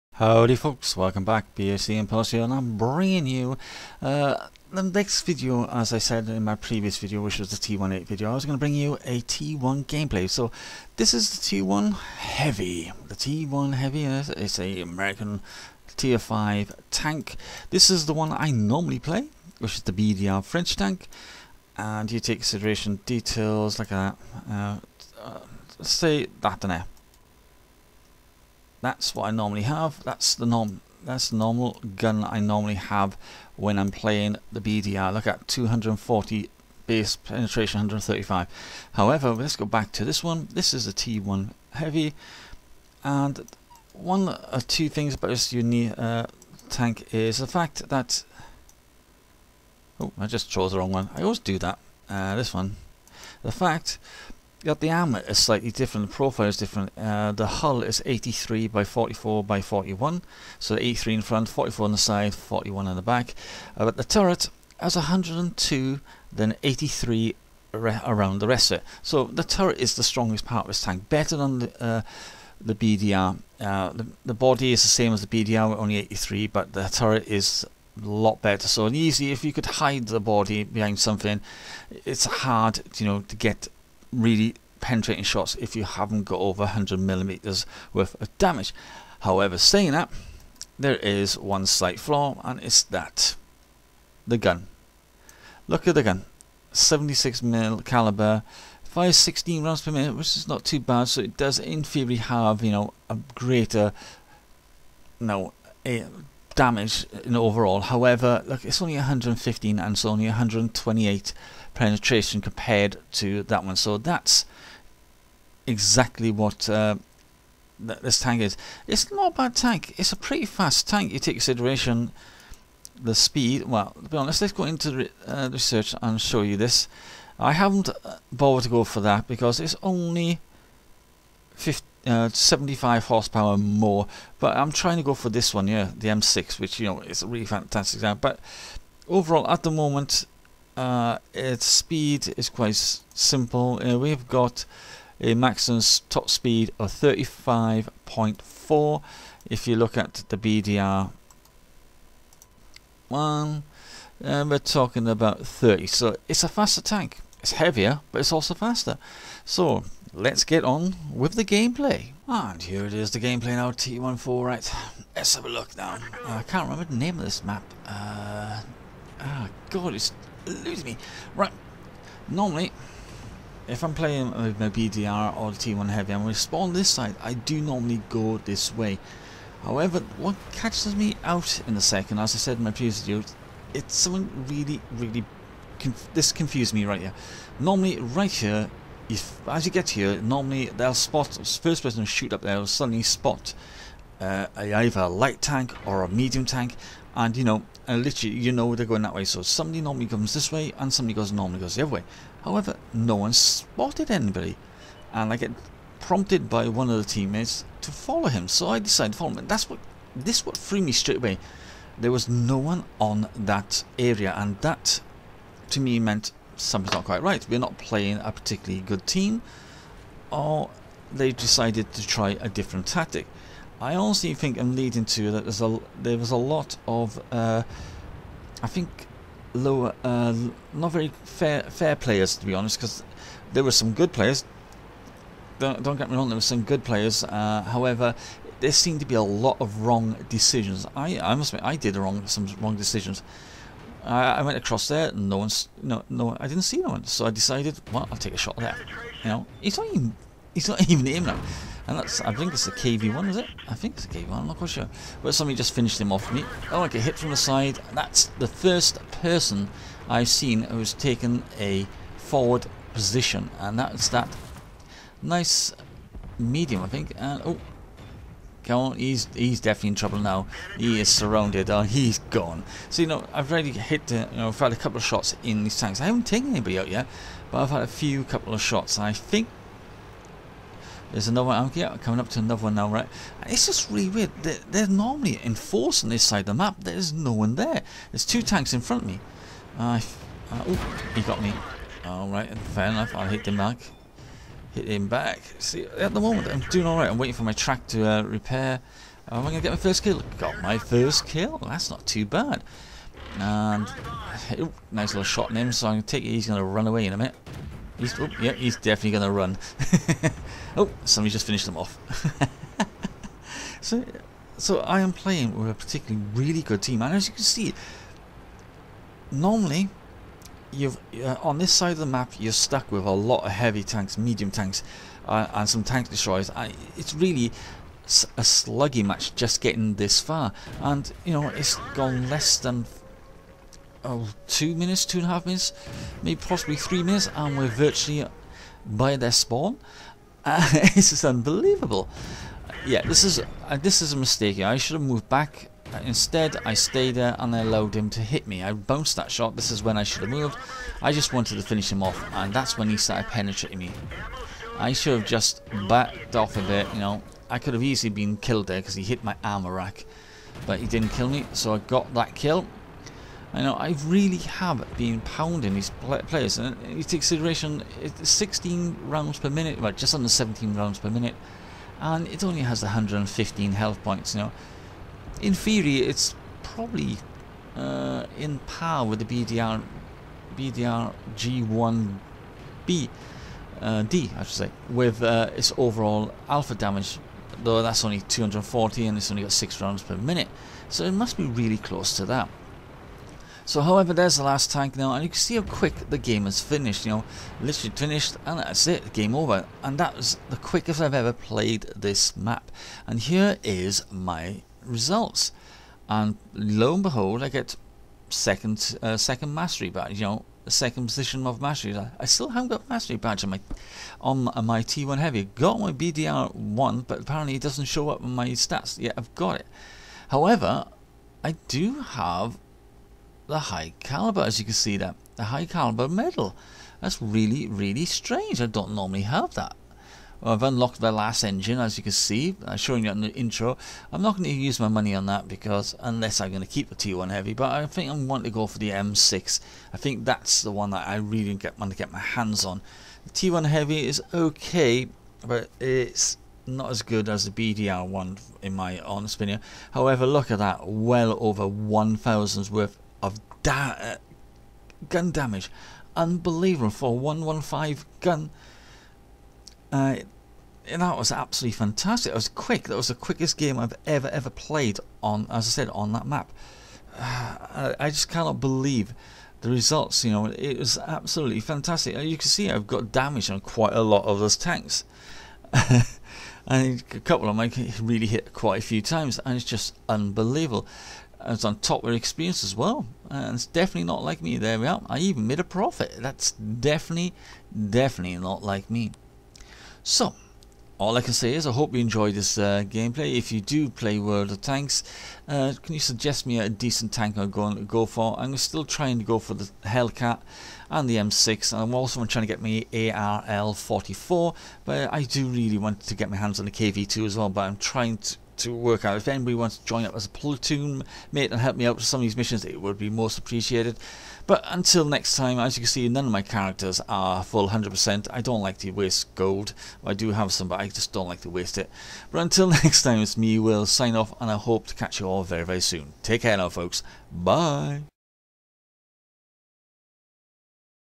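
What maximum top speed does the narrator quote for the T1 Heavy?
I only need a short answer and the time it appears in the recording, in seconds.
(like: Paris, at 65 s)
35.4, at 146 s.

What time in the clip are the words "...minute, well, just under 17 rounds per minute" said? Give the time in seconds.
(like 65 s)
369 s.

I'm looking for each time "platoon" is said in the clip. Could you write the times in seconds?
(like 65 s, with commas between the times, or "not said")
510 s.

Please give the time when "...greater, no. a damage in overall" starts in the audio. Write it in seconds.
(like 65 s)
103 s.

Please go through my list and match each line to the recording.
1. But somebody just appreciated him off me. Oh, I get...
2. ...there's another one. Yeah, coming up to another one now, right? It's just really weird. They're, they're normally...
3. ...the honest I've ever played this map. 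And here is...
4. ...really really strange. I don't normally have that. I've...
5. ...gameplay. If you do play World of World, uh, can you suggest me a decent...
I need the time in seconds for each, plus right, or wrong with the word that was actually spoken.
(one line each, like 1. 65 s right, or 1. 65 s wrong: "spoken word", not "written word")
1. 255 s wrong: "finished", not "appreciated"
2. 281 s right
3. 400 s wrong: "quickest", not "honest"
4. 427 s right
5. 492 s wrong: "Tanks", not "World".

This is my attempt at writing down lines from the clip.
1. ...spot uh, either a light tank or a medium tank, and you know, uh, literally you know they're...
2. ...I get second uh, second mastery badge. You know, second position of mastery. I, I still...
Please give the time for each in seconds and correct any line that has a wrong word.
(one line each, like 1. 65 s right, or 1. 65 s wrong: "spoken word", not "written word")
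1. 193 s right
2. 407 s right.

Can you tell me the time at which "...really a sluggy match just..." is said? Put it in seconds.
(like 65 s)
327 s.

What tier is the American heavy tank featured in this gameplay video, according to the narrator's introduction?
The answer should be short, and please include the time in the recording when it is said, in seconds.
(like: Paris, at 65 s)
Tier 5, at 15 s.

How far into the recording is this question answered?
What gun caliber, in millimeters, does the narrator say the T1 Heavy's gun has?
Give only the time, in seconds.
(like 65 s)
96 s.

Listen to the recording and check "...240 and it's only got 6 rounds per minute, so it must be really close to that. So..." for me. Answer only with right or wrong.
right.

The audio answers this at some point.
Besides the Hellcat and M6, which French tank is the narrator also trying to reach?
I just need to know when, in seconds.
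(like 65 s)
502 s.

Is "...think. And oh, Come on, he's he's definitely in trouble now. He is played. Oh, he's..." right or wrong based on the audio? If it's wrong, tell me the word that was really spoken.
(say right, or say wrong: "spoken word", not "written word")
wrong: "surrounded", not "played".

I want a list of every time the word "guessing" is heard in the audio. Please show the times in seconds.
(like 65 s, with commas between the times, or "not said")
not said.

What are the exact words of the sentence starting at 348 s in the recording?
I bounced that shot, this is when I should have moved.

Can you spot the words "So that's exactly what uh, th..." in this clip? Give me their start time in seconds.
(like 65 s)
113 s.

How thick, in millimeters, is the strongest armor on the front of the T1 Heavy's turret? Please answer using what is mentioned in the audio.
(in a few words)
102.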